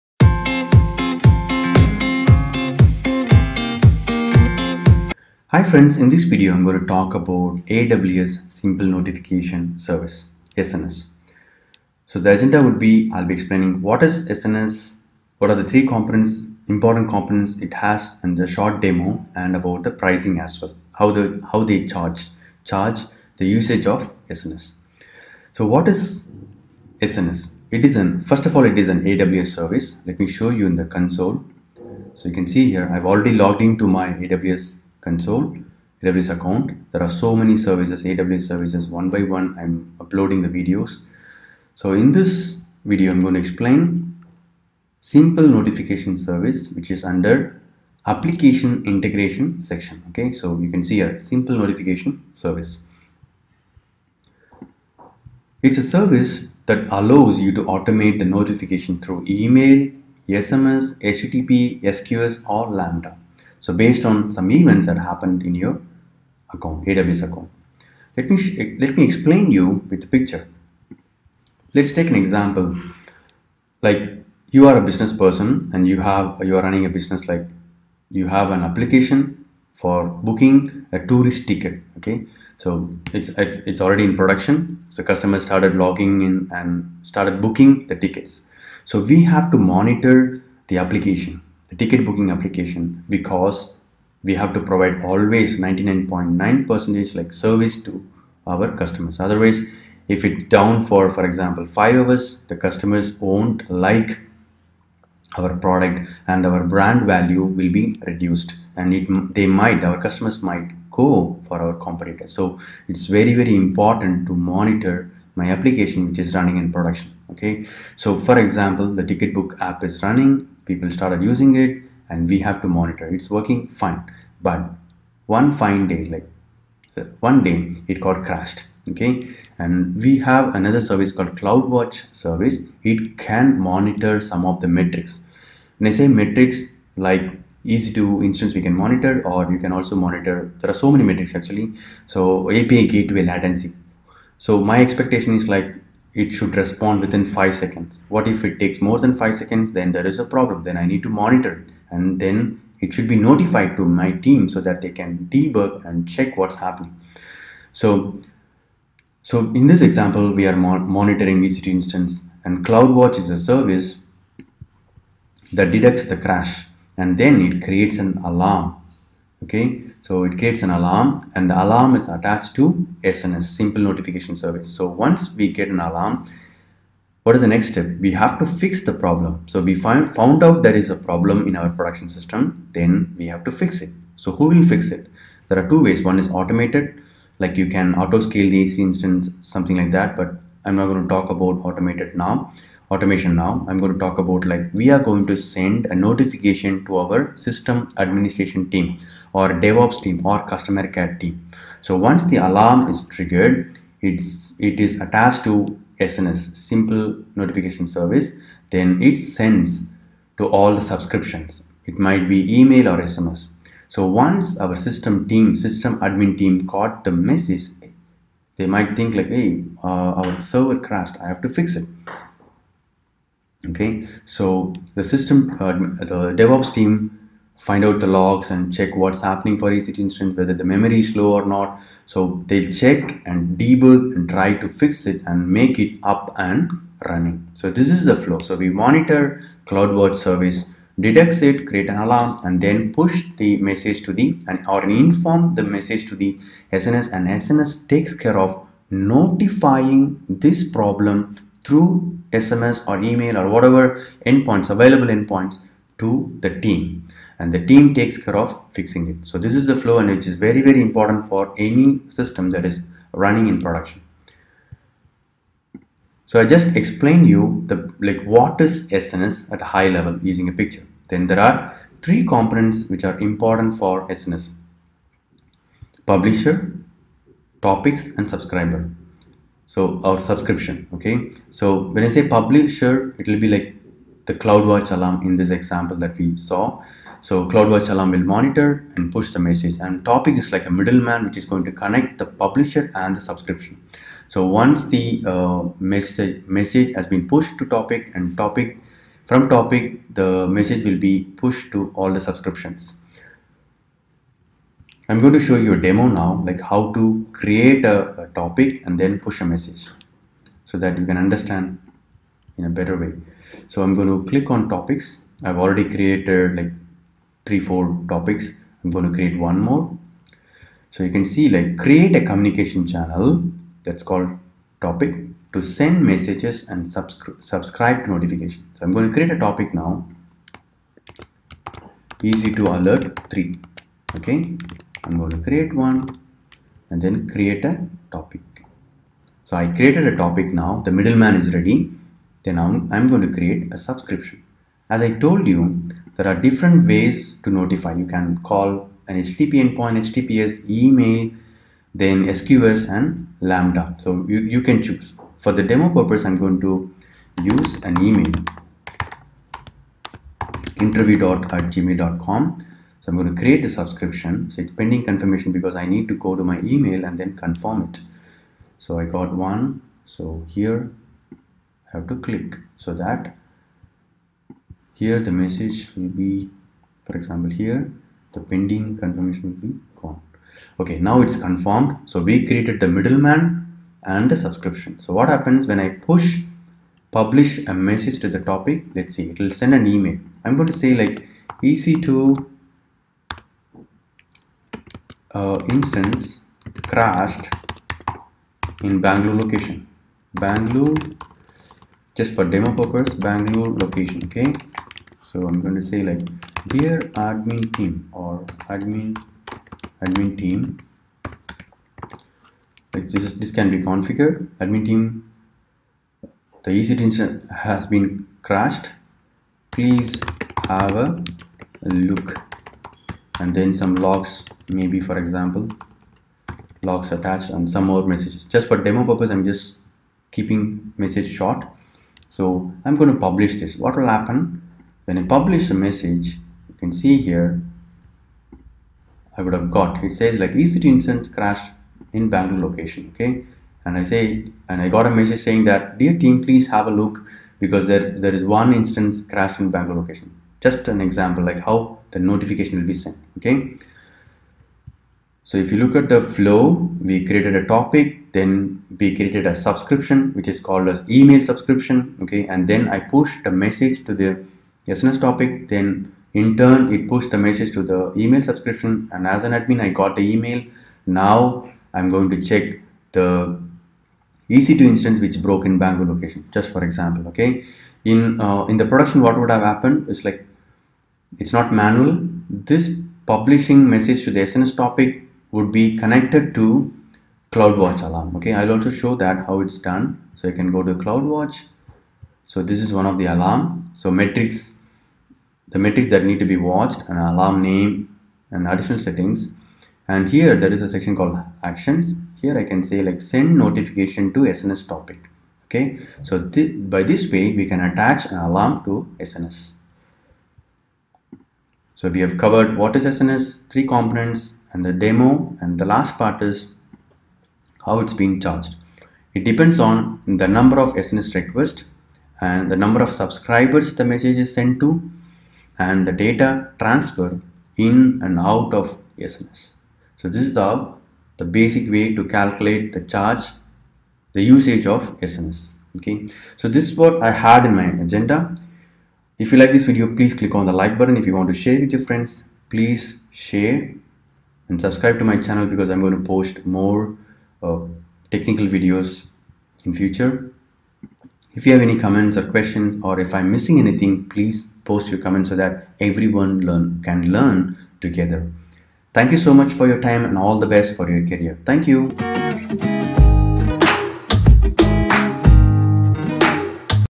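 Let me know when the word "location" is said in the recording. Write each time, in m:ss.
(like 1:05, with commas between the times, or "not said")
6:39, 6:43, 7:22, 7:30, 7:56.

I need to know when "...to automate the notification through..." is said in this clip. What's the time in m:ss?
0:57.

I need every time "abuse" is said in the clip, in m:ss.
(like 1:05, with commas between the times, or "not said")
not said.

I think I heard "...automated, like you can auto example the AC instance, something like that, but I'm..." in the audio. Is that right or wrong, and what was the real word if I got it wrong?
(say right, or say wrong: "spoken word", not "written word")
wrong: "scale", not "example".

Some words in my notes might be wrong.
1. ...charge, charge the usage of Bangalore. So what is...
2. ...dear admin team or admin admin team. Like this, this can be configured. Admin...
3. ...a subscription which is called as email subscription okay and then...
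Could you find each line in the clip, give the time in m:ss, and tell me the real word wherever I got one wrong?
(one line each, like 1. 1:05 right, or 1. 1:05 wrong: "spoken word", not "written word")
1. 0:21 wrong: "SNS", not "Bangalore"
2. 6:46 right
3. 7:39 right.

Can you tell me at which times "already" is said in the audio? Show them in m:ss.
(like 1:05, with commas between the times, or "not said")
0:33, 1:23, 5:15.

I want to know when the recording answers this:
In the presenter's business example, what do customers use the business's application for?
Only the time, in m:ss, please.
1:20.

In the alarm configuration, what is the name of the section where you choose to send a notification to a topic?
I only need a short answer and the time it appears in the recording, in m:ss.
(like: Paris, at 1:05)
Actions, at 8:21.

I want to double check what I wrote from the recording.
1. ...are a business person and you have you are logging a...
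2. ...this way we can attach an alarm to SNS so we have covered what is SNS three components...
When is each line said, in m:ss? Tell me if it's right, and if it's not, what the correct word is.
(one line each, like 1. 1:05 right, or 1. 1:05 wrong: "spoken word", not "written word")
1. 1:14 wrong: "running", not "logging"
2. 8:27 right.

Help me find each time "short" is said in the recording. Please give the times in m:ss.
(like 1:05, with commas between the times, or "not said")
0:18, 7:11.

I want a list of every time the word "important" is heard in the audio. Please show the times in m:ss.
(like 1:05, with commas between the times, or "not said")
0:16, 1:53, 4:20, 4:33.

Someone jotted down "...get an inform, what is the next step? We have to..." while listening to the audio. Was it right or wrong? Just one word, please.
wrong.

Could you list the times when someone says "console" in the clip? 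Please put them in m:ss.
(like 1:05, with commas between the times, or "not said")
0:30, 0:35.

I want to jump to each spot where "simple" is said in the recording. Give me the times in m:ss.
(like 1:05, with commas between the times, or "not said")
0:08, 0:44, 0:51, 2:53, 3:26.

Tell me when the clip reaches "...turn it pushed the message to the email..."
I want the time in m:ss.
7:46.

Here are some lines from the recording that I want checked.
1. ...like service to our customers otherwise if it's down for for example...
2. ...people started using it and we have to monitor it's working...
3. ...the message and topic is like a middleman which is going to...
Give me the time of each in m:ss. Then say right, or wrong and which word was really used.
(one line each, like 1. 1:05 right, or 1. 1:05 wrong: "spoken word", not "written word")
1. 1:37 right
2. 2:00 right
3. 4:49 right.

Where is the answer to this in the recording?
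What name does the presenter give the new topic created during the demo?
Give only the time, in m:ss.
5:32.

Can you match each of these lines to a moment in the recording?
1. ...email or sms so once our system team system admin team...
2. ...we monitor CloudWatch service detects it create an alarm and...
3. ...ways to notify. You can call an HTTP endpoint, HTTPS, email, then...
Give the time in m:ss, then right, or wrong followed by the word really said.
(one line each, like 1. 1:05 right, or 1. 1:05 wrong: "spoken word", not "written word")
1. 3:32 right
2. 3:58 right
3. 5:46 right.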